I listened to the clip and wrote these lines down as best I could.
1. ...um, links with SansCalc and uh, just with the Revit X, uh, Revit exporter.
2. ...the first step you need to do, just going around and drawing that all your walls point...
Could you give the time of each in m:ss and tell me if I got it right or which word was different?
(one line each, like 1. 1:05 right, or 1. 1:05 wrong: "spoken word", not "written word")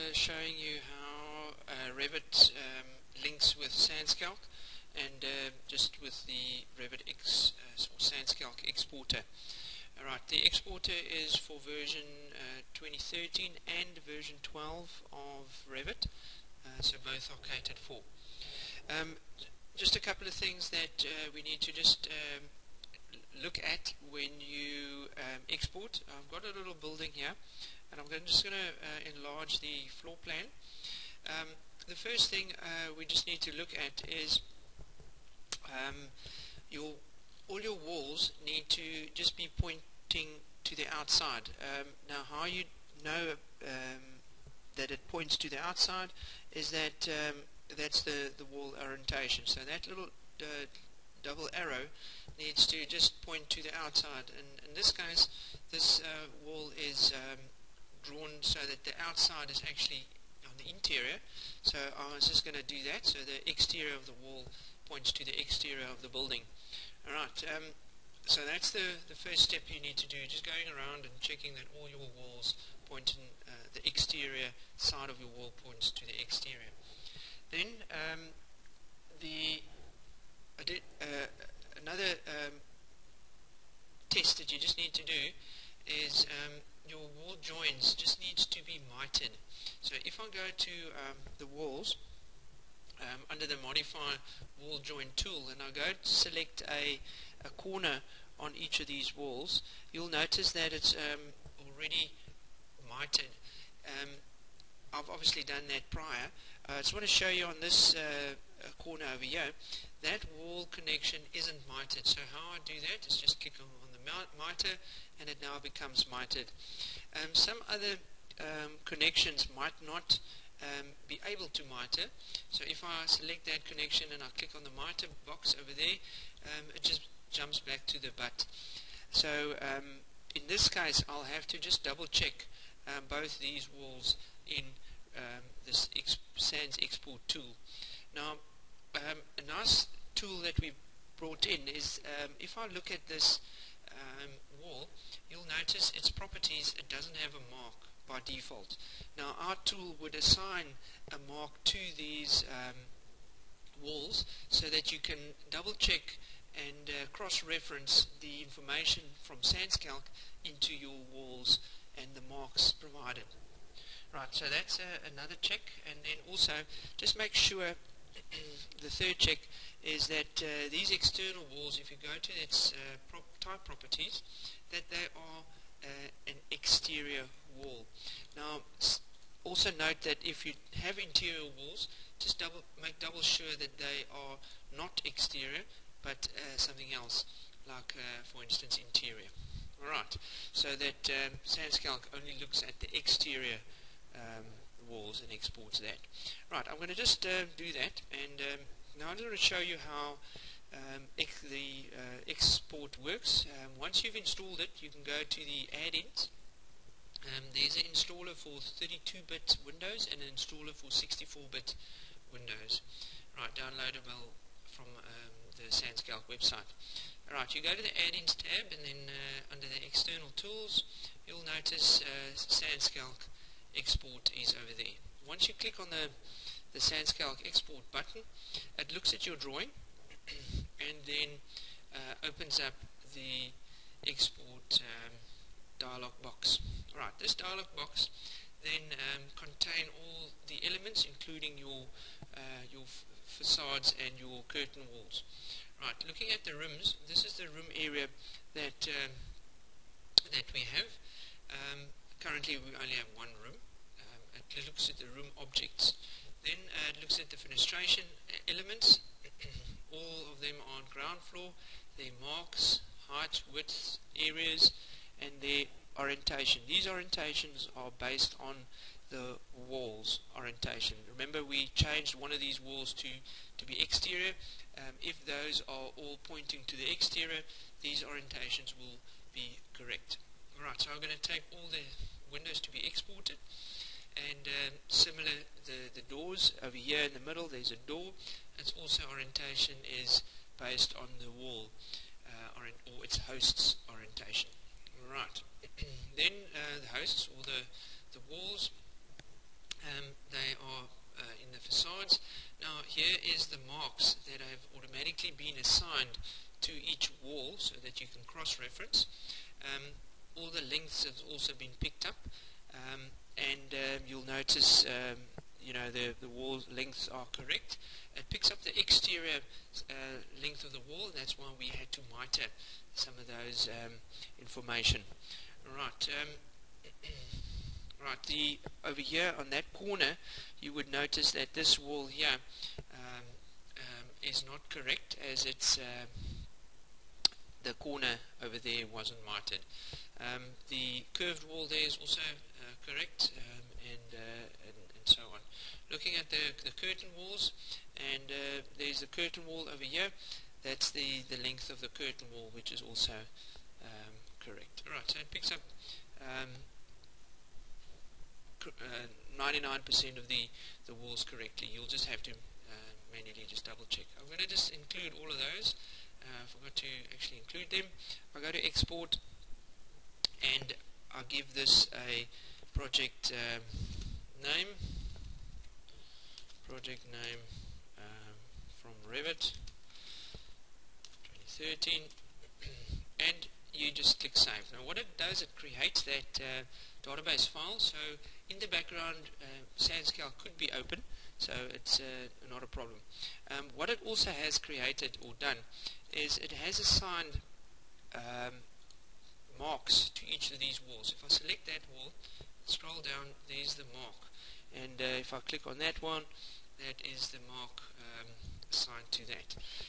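1. 0:02 wrong: "SansCalc", not "Revit"
2. 1:09 wrong: "checking", not "drawing".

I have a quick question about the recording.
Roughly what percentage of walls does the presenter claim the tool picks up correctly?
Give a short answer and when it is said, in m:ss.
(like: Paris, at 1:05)
99%, at 5:58.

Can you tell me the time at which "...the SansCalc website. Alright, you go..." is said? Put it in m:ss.
3:35.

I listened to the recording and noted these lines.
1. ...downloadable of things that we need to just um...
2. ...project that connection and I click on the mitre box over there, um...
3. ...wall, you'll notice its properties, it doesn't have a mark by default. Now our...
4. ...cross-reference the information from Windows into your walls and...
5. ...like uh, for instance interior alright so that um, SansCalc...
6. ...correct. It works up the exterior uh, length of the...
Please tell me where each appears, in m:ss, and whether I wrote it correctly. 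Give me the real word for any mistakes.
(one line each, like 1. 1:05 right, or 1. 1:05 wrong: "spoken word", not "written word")
1. 0:20 wrong: "couple", not "downloadable"
2. 2:03 wrong: "select", not "project"
3. 2:24 right
4. 2:37 wrong: "SansCalc", not "Windows"
5. 3:07 right
6. 5:17 wrong: "picks", not "works".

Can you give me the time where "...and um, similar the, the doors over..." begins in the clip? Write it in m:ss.
4:44.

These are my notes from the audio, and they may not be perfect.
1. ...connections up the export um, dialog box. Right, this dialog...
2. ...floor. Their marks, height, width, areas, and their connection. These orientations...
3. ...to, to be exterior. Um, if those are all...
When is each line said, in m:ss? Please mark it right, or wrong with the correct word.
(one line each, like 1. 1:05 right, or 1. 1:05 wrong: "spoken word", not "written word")
1. 3:52 wrong: "opens", not "connections"
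2. 4:21 wrong: "orientation", not "connection"
3. 4:32 right.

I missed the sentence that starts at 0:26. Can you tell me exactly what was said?
I've got a little building here and I'm going just going to uh, enlarge the floor plan.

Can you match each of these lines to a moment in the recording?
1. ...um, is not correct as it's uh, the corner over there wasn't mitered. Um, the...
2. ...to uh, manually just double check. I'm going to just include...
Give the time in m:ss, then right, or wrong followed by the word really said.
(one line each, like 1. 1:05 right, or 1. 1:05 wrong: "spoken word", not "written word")
1. 5:33 right
2. 6:02 right.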